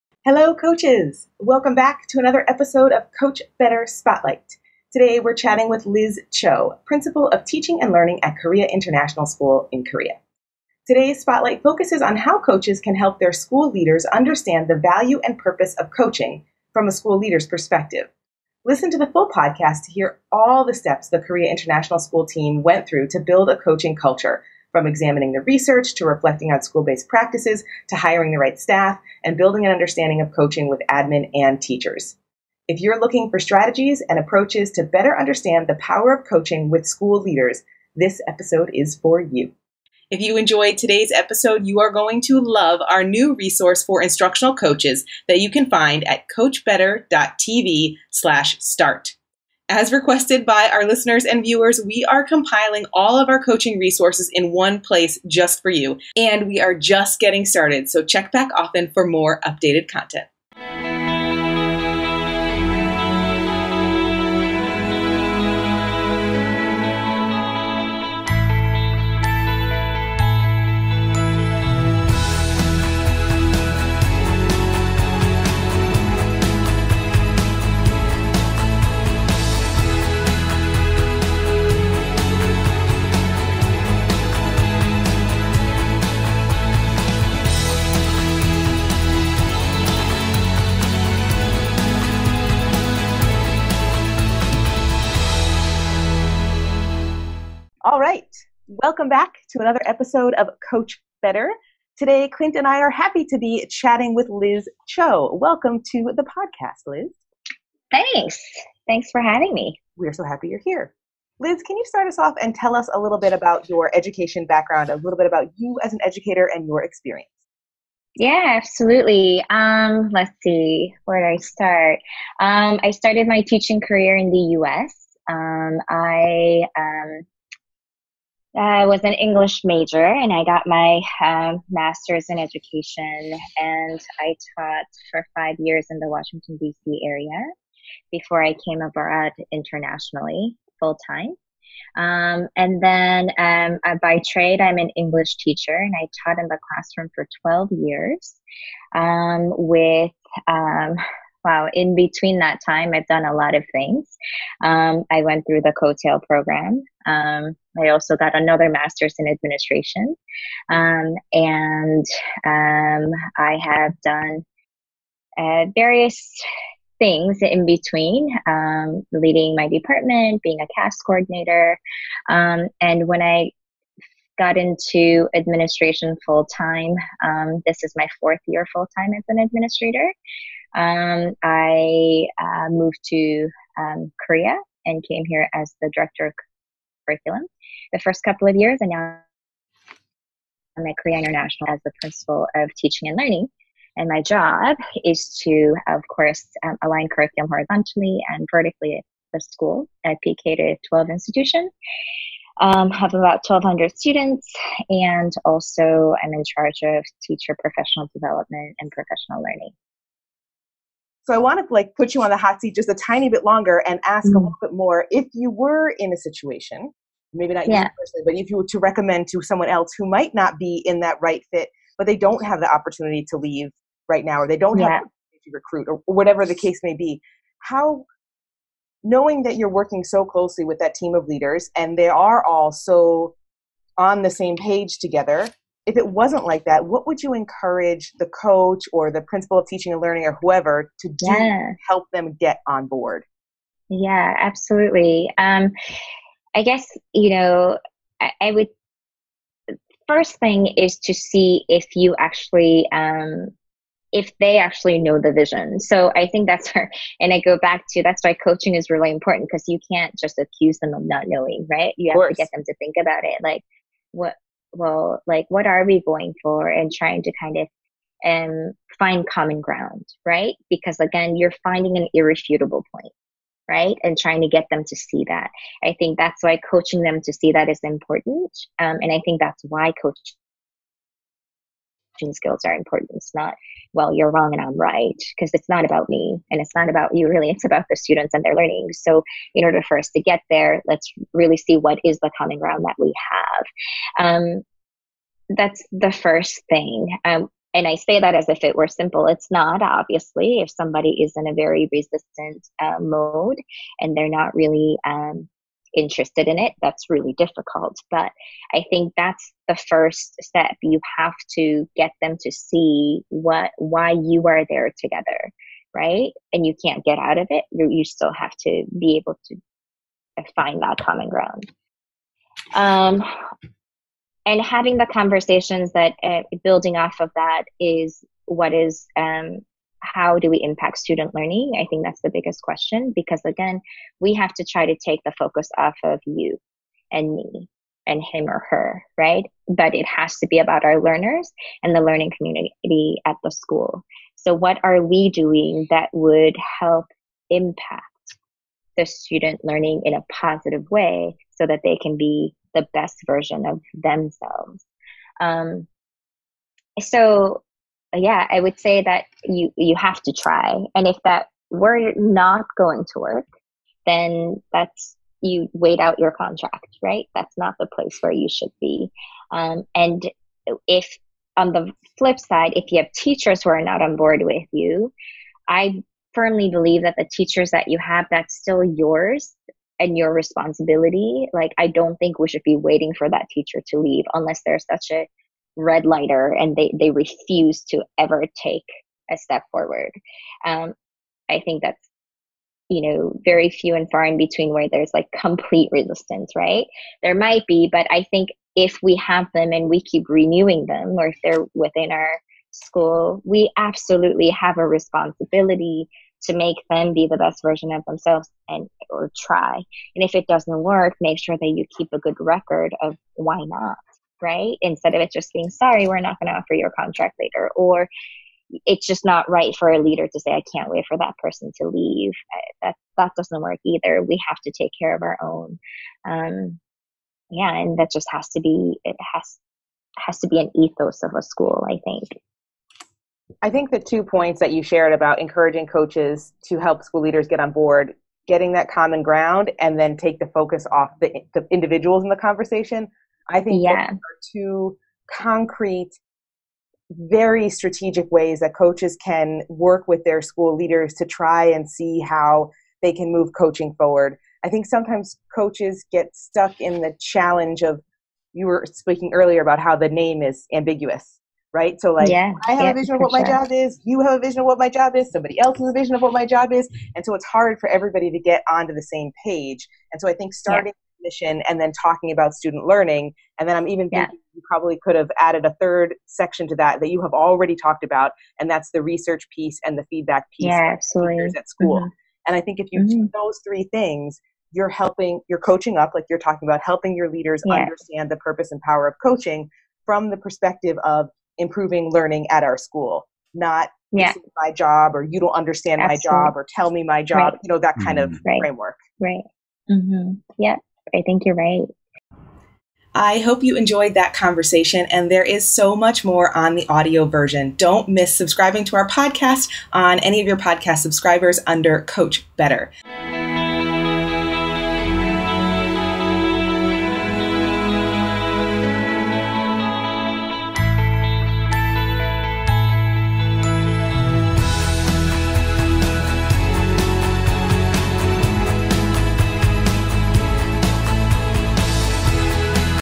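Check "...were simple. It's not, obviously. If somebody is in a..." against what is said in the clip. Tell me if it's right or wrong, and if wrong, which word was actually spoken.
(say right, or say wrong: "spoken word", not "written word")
right.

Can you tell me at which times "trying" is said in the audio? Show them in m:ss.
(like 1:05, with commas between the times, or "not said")
4:26, 4:34.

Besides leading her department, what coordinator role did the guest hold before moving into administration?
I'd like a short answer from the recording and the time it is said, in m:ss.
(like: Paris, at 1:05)
CAS coordinator, at 2:50.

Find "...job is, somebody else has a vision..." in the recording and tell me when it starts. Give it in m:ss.
7:44.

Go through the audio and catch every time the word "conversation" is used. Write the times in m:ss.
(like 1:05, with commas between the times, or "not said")
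5:25, 7:22, 8:24.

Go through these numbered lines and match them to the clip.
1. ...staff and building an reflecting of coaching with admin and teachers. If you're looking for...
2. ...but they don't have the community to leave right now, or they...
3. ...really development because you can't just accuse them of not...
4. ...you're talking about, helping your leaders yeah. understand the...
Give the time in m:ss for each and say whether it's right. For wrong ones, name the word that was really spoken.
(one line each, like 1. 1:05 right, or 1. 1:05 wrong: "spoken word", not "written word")
1. 0:28 wrong: "understanding", not "reflecting"
2. 3:41 wrong: "opportunity", not "community"
3. 4:18 wrong: "important", not "development"
4. 8:06 right.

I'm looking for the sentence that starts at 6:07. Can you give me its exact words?
That's not the place where you should be.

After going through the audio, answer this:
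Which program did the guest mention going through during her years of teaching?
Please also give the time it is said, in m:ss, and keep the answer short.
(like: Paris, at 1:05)
COETAIL, at 2:35.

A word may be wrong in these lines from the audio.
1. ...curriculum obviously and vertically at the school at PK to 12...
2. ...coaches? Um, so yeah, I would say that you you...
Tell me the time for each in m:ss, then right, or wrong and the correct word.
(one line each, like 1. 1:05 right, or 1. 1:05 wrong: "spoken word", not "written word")
1. 3:17 wrong: "horizontally", not "obviously"
2. 5:54 wrong: "themselves", not "coaches".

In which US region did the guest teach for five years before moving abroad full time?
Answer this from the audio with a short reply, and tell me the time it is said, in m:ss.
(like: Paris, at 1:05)
Washington DC area, at 2:16.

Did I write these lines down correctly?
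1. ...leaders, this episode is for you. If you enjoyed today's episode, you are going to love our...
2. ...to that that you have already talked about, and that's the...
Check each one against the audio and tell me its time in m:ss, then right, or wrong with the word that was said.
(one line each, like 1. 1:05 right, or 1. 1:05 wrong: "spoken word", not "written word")
1. 0:37 right
2. 7:56 right.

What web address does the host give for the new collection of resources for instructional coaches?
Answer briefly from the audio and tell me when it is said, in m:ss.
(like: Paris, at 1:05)
coachbetter.tv/start, at 0:46.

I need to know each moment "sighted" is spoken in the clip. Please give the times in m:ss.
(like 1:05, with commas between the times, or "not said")
not said.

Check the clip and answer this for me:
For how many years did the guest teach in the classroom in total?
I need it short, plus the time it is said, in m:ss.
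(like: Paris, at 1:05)
12, at 2:27.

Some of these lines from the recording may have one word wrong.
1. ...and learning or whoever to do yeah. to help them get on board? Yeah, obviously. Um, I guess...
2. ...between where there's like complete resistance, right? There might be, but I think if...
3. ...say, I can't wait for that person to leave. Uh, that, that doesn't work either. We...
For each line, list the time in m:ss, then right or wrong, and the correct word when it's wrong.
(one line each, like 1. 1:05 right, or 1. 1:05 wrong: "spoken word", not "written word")
1. 3:59 wrong: "absolutely", not "obviously"
2. 6:34 right
3. 7:00 right.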